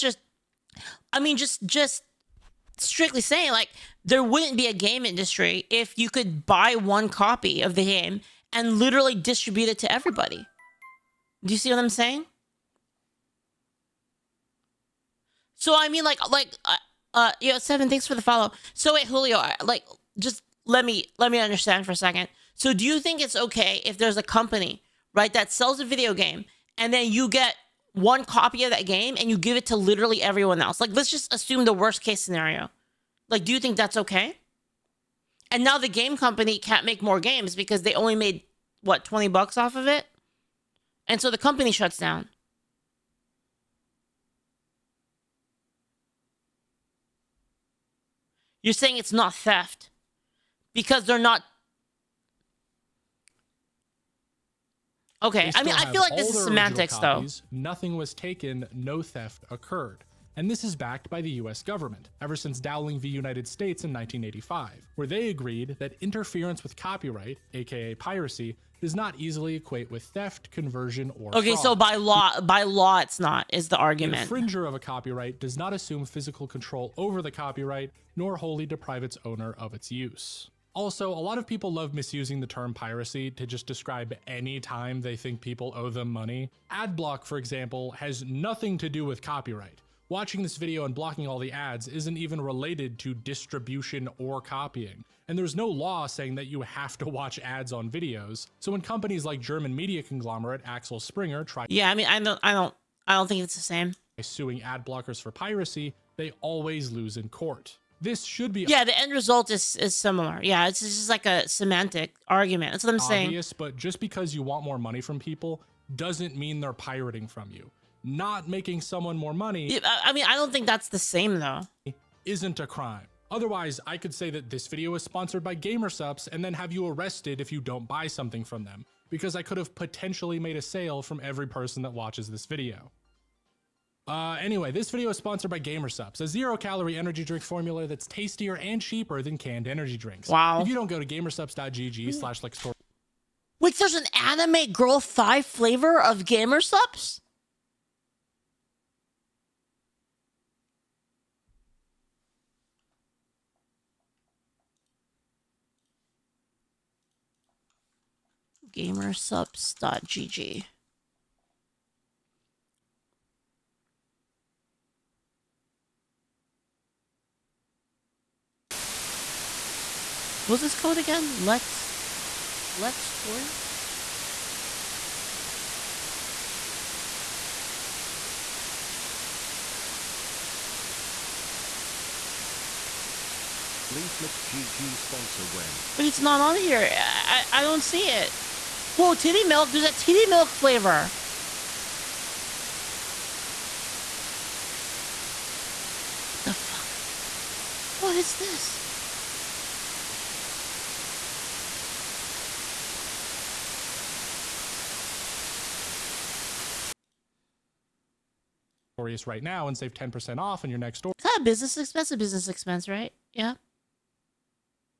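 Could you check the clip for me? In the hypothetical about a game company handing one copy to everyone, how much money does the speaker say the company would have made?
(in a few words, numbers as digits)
20 bucks.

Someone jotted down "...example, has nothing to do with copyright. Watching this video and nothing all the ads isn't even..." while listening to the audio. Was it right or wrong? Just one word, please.
wrong.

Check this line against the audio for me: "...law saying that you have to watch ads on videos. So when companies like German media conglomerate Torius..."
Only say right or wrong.
wrong.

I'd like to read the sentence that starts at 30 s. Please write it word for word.
Like, let's just assume the worst case scenario.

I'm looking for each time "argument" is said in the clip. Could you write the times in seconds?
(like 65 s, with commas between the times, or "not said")
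73 s, 112 s.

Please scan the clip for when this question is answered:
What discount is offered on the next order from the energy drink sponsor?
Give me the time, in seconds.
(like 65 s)
209 s.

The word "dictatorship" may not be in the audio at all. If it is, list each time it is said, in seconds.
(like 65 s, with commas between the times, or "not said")
not said.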